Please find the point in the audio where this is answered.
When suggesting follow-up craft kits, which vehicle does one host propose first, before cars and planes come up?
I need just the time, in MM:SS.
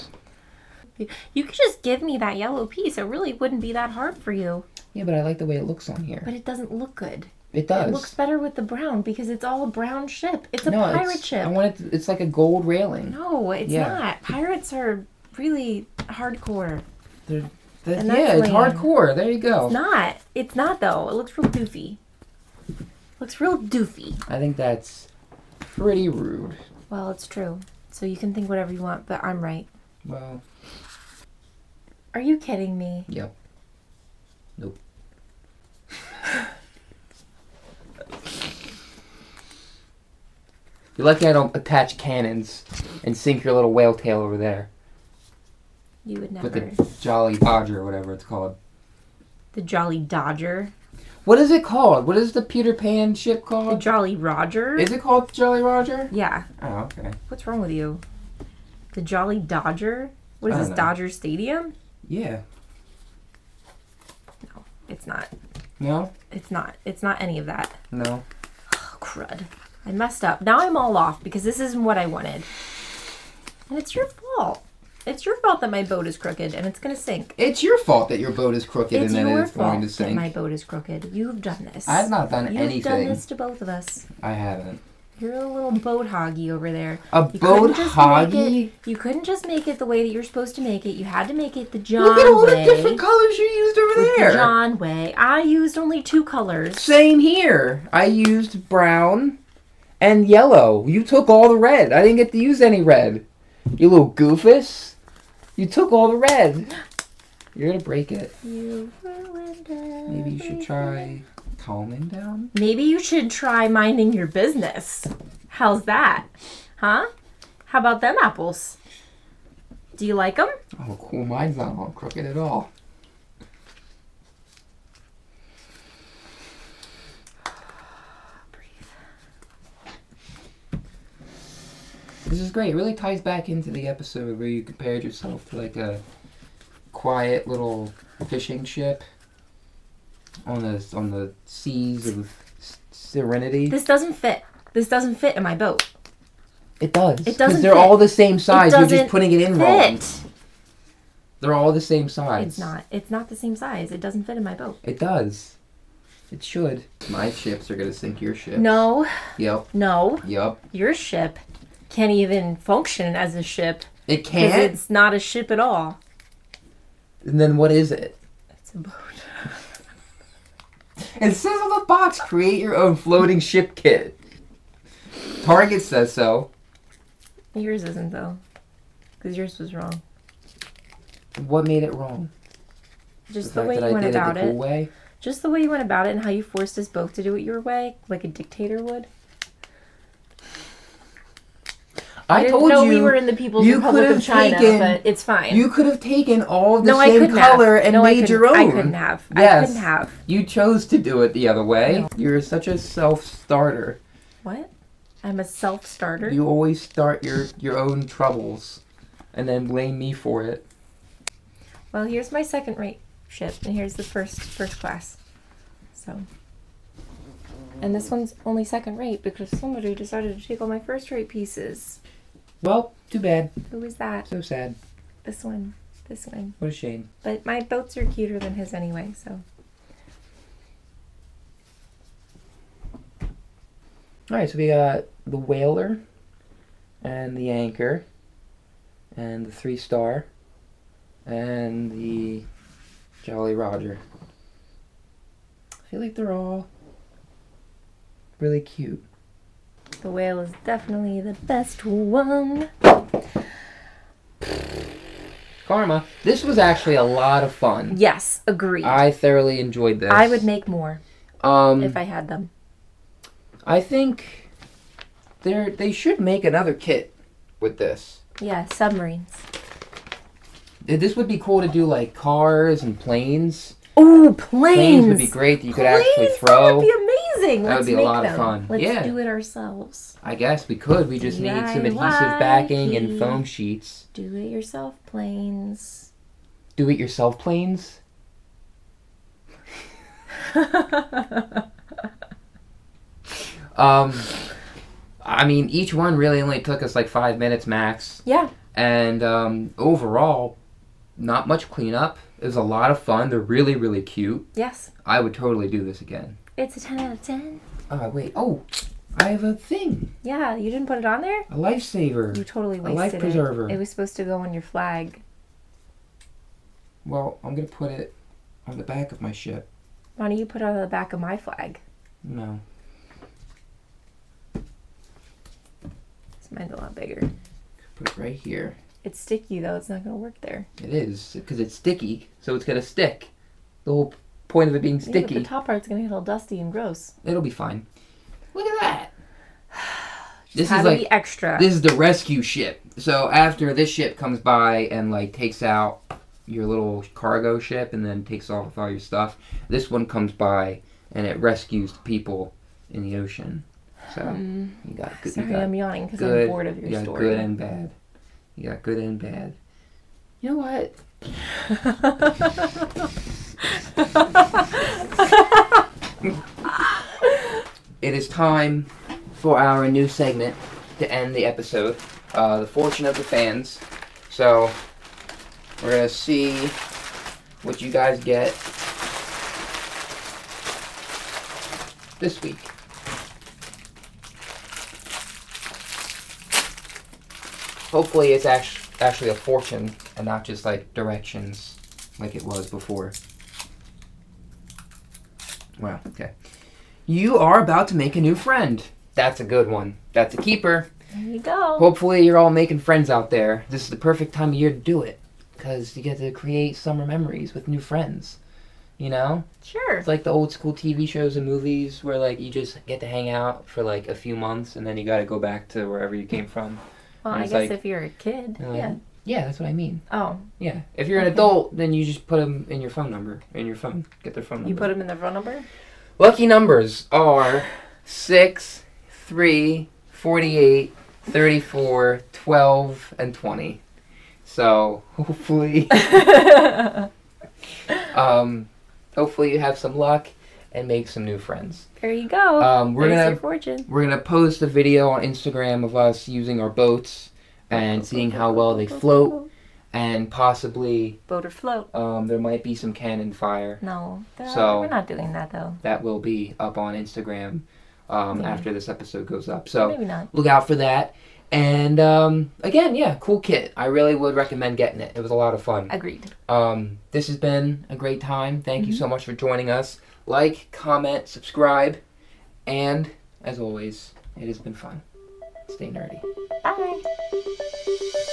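04:28.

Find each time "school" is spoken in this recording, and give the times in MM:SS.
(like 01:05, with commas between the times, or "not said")
06:50.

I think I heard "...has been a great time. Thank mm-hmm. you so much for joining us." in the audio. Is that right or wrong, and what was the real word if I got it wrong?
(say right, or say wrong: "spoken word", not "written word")
right.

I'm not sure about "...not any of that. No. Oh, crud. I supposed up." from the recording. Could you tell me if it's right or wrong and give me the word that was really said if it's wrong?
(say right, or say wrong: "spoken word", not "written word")
wrong: "messed", not "supposed".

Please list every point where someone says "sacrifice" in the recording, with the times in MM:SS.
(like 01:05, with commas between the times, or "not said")
not said.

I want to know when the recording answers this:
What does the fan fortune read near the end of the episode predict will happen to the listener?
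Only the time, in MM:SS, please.
06:37.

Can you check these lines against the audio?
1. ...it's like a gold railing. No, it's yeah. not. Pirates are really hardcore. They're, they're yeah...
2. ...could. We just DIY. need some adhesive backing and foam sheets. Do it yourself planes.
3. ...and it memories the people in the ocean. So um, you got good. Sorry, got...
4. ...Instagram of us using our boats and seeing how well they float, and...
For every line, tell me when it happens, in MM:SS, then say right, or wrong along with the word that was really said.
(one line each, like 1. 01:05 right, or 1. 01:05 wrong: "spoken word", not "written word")
1. 00:11 right
2. 04:40 right
3. 05:51 wrong: "rescues", not "memories"
4. 07:25 right.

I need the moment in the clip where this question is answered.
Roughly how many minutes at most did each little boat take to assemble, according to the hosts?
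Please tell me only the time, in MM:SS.
04:57.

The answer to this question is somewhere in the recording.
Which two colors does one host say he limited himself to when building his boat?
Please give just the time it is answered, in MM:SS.
01:38.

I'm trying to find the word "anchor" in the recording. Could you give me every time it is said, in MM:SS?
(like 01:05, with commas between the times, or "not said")
03:57.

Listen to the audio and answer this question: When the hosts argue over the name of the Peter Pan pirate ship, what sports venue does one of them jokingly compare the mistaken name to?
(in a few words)
Dodger Stadium.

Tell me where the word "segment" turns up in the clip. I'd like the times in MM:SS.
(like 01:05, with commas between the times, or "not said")
06:10.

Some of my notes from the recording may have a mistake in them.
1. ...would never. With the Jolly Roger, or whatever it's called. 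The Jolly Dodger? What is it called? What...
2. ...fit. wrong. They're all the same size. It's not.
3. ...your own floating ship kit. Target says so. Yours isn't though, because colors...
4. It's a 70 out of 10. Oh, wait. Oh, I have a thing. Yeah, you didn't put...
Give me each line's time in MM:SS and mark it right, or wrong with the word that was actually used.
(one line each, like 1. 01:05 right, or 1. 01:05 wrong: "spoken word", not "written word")
1. 00:46 wrong: "Dodger", not "Roger"
2. 02:29 right
3. 02:52 wrong: "yours", not "colors"
4. 05:06 wrong: "10", not "70".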